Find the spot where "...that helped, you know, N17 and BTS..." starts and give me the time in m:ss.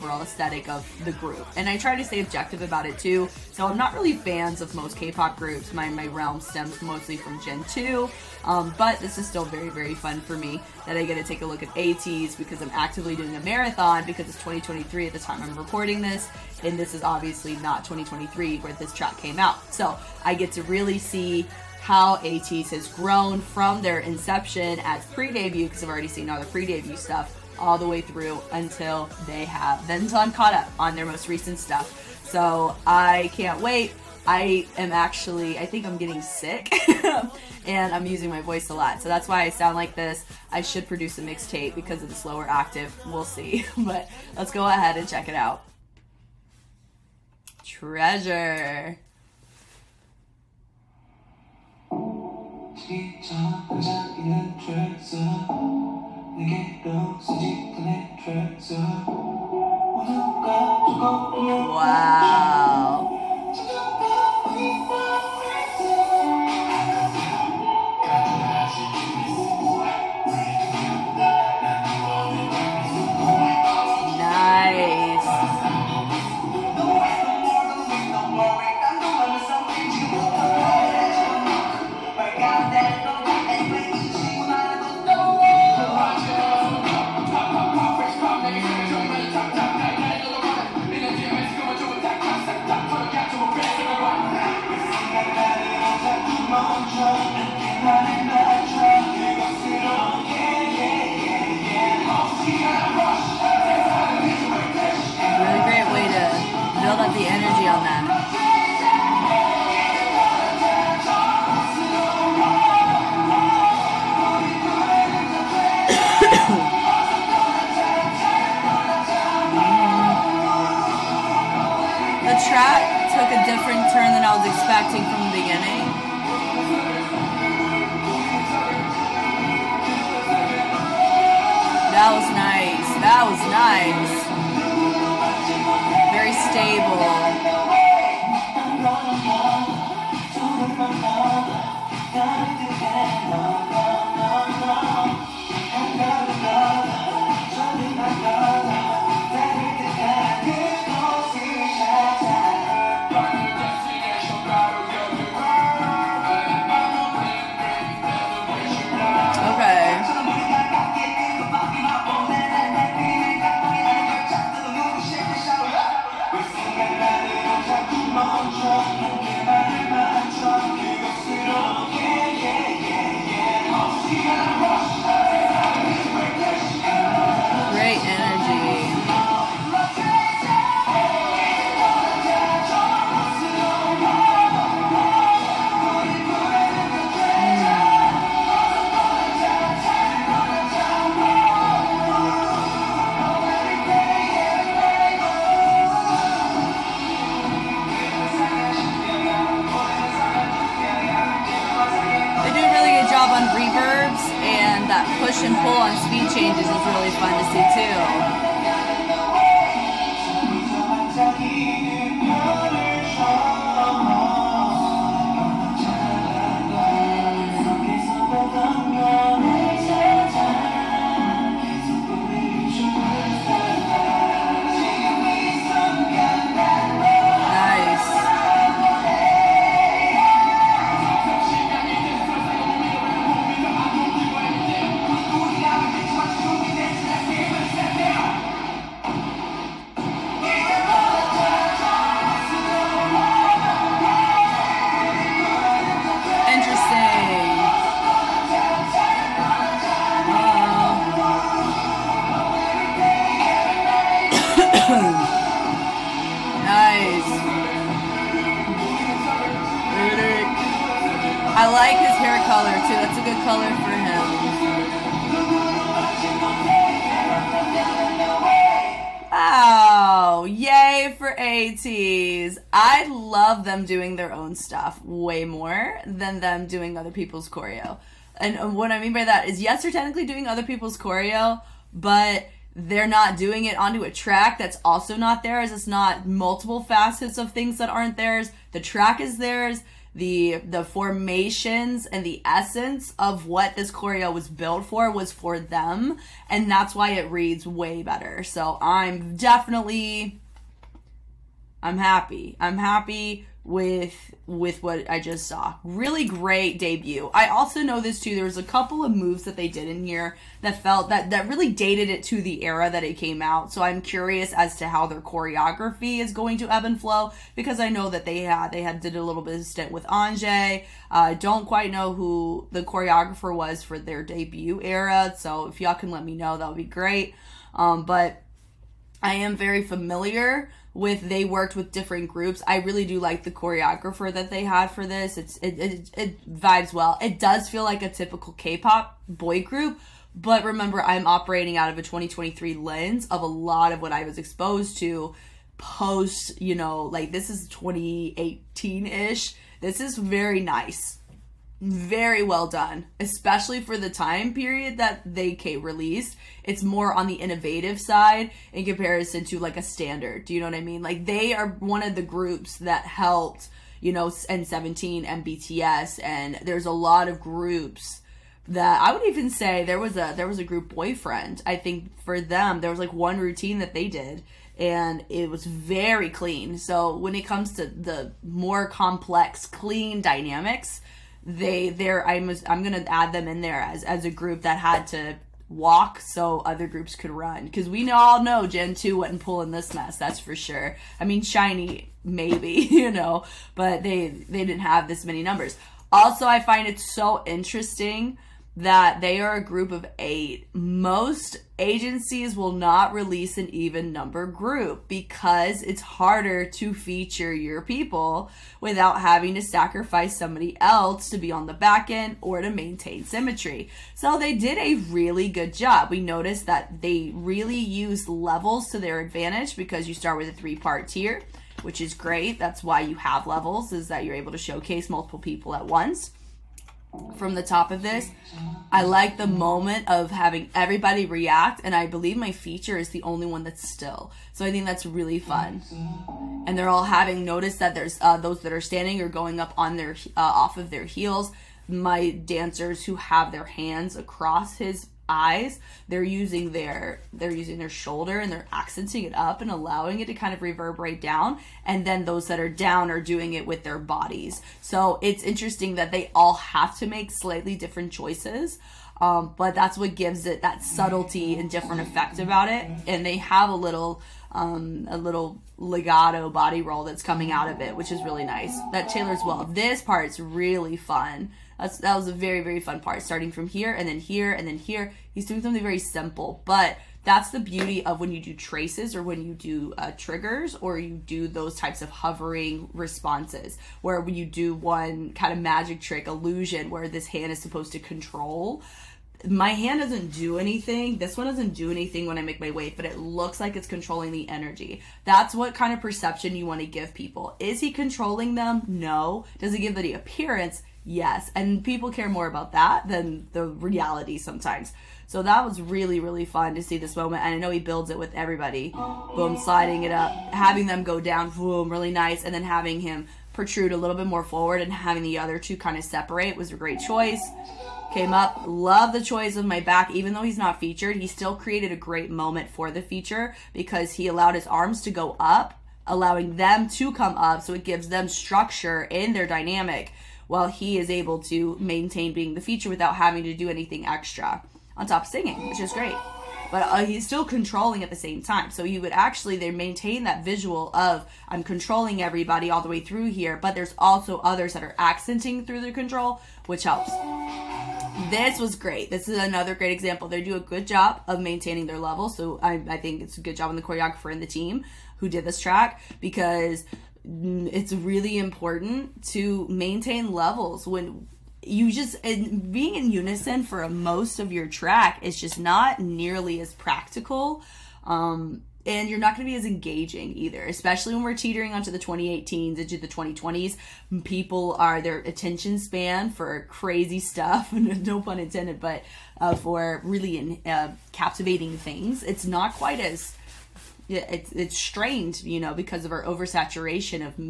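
6:02.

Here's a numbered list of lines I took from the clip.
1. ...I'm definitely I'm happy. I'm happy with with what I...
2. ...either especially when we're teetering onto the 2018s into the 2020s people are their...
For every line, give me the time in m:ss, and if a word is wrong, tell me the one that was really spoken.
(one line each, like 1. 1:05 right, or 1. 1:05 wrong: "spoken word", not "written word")
1. 4:58 right
2. 9:30 right.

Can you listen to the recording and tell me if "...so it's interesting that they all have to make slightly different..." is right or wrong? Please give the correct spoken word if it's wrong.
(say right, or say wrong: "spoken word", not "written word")
right.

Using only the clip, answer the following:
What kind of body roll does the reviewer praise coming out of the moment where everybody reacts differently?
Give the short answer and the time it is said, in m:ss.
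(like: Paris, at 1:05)
legato, at 7:45.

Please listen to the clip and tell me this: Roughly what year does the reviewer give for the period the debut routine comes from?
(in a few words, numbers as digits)
2018-ish.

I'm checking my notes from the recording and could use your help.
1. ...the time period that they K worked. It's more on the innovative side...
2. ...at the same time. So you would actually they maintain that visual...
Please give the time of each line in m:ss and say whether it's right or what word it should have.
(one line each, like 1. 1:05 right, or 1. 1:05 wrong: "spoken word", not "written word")
1. 5:53 wrong: "released", not "worked"
2. 8:58 right.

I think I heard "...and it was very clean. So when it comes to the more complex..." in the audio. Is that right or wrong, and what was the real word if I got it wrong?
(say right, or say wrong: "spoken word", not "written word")
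right.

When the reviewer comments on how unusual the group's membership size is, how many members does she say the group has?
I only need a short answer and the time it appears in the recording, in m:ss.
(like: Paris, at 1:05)
8, at 6:40.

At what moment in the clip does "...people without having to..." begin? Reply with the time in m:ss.
6:47.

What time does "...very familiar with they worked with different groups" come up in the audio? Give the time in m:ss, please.
5:29.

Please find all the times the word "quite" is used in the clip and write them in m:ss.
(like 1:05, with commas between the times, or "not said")
5:21, 9:42.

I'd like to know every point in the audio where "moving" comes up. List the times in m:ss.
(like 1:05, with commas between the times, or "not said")
not said.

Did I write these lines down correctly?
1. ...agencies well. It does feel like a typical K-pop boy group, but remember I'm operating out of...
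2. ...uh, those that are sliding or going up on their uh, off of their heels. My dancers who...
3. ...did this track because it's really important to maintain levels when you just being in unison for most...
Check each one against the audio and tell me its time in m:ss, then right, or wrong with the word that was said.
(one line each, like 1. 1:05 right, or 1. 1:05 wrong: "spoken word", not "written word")
1. 5:36 wrong: "vibes", not "agencies"
2. 7:18 wrong: "standing", not "sliding"
3. 9:15 right.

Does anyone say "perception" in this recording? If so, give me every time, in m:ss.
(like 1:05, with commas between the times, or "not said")
8:16.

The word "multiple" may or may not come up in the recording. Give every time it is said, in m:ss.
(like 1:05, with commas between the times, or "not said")
4:46, 7:05.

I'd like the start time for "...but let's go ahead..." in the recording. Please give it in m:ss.
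0:43.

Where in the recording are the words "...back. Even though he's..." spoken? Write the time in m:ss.
8:39.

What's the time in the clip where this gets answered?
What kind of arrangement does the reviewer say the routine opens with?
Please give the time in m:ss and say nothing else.
7:00.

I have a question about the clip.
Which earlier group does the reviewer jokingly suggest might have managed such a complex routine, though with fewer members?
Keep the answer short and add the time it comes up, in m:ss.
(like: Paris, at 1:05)
SHINee, at 6:31.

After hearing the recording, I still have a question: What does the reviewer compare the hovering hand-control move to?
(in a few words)
magic trick illusion.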